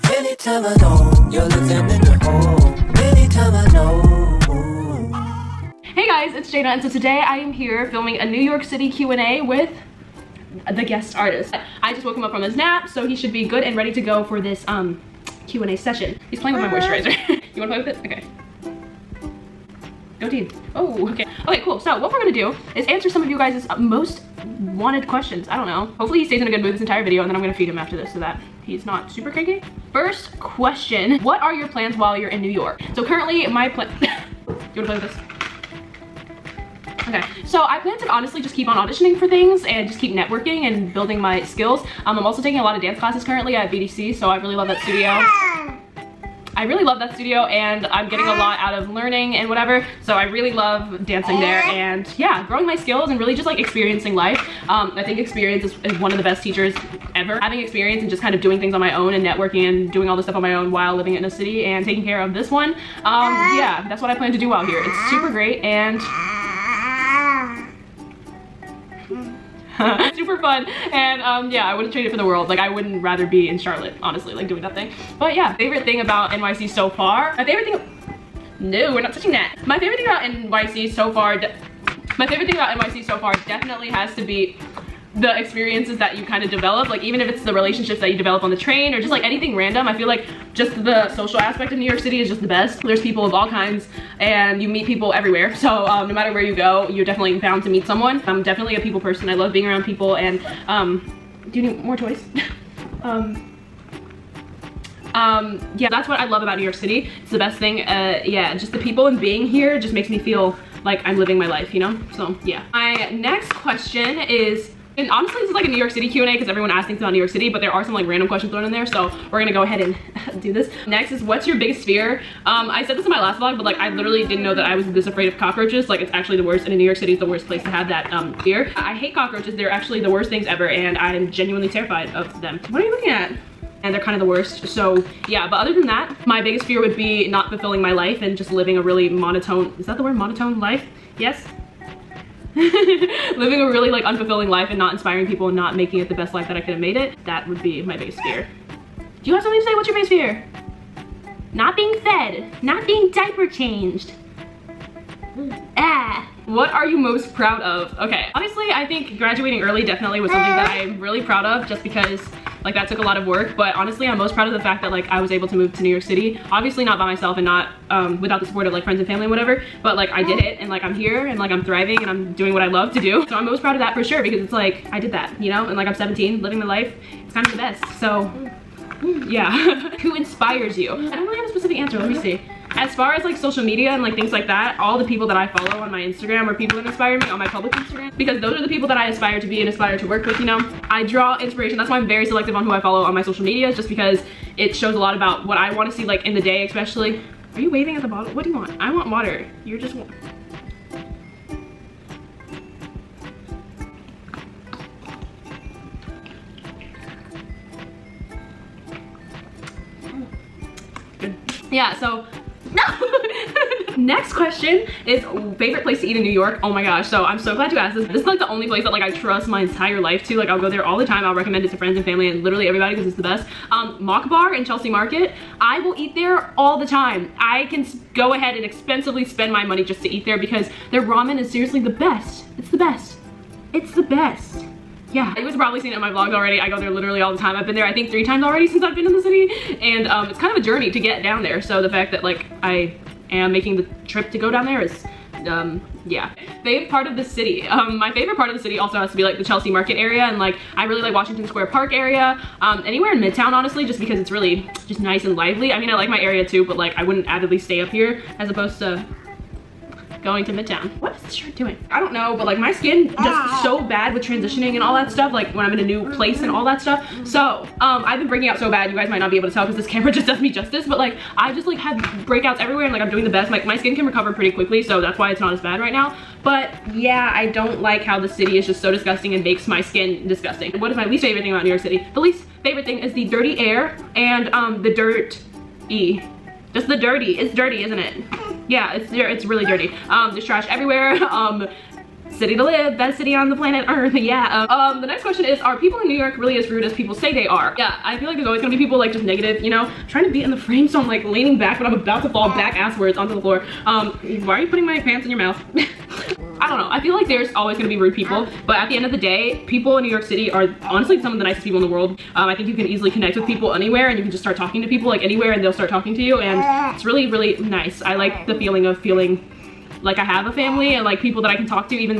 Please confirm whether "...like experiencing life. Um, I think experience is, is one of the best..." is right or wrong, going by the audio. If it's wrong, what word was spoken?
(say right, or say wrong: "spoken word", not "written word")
right.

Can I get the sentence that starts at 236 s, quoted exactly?
I go there literally all the time.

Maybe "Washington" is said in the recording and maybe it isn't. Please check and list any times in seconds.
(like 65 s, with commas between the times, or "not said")
251 s.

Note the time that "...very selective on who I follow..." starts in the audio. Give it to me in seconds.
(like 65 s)
192 s.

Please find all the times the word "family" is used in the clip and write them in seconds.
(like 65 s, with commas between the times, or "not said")
169 s, 222 s, 320 s.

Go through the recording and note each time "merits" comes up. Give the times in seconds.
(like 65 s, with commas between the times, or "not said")
not said.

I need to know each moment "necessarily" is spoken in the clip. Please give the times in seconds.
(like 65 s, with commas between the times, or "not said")
not said.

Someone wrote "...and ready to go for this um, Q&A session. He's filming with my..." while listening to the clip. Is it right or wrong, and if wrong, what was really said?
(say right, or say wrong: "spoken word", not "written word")
wrong: "playing", not "filming".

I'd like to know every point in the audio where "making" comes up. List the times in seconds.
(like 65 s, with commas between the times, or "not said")
145 s, 243 s.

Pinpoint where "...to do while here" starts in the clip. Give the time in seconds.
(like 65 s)
64 s.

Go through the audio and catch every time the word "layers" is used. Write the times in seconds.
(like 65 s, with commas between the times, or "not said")
not said.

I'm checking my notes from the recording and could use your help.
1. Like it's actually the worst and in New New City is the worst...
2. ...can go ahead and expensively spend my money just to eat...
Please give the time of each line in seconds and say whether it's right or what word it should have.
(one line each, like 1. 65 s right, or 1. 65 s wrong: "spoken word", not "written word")
1. 125 s wrong: "York", not "New"
2. 227 s right.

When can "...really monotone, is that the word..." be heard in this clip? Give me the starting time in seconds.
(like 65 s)
138 s.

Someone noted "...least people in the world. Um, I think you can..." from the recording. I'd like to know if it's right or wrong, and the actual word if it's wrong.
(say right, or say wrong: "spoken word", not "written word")
wrong: "nicest", not "least".